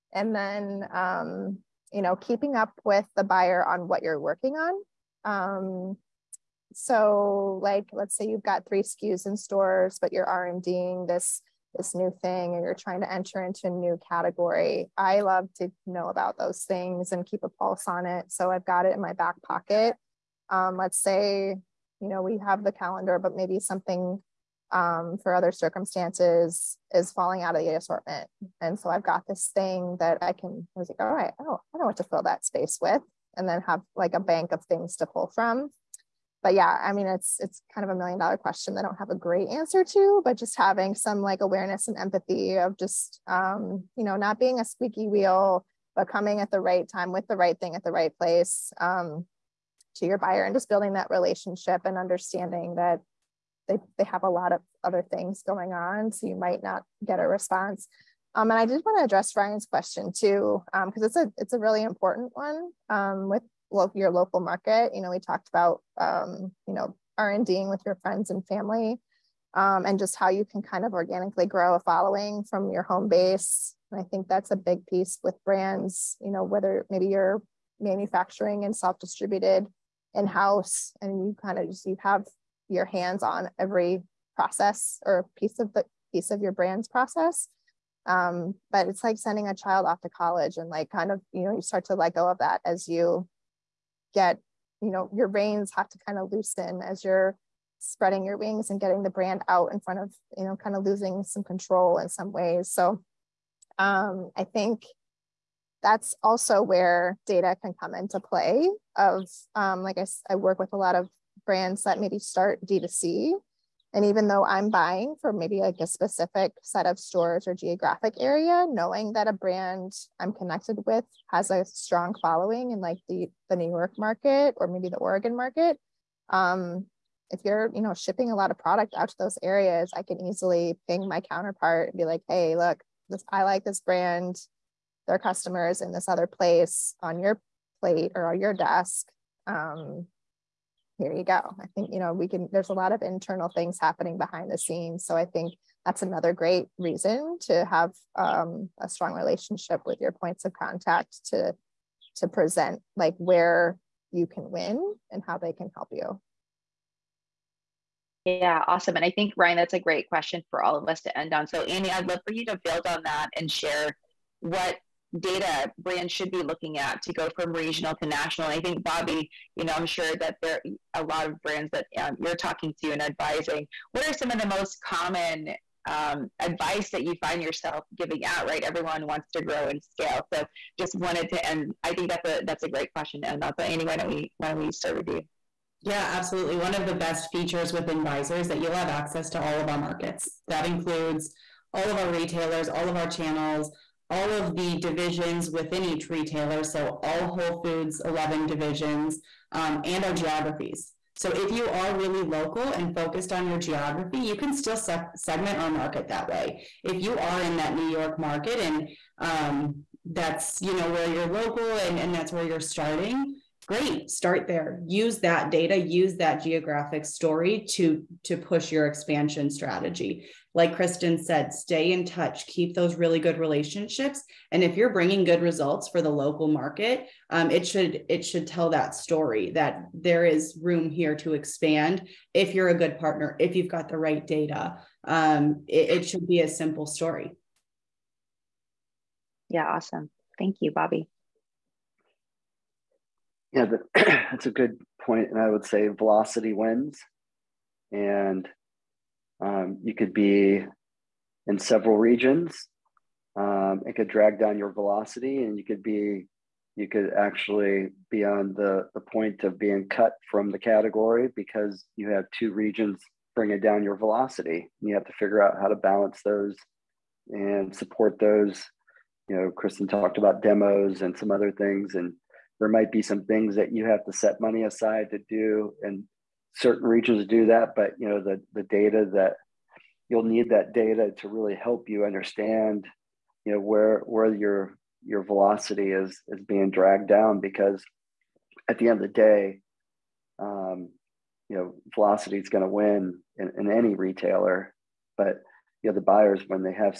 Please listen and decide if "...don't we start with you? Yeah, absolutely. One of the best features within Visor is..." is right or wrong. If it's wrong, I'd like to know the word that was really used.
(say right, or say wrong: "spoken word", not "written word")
right.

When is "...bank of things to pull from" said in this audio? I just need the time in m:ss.
0:34.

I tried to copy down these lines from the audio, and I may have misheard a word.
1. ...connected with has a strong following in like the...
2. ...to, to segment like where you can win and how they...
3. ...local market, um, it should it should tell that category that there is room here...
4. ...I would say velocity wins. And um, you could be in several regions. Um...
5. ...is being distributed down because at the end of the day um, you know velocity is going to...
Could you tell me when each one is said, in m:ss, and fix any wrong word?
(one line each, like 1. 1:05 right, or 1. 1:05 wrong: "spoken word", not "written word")
1. 2:00 right
2. 2:31 wrong: "present", not "segment"
3. 3:46 wrong: "story", not "category"
4. 4:05 right
5. 4:46 wrong: "dragged", not "distributed".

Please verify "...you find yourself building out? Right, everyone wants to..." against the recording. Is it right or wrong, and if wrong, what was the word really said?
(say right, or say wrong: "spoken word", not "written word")
wrong: "giving", not "building".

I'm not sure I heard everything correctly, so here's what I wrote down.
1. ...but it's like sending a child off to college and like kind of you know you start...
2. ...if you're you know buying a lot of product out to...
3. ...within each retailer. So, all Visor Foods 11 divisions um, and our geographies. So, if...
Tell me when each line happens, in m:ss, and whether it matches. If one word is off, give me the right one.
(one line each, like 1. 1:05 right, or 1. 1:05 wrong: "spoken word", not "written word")
1. 1:28 right
2. 2:07 wrong: "shipping", not "buying"
3. 3:15 wrong: "Whole", not "Visor".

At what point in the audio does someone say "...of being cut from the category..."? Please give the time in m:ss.
4:19.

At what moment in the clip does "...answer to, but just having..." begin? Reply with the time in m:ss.
0:39.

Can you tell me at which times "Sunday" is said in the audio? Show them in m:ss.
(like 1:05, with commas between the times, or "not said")
not said.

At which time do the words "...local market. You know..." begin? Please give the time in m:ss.
1:04.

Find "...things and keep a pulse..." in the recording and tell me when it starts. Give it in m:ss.
0:16.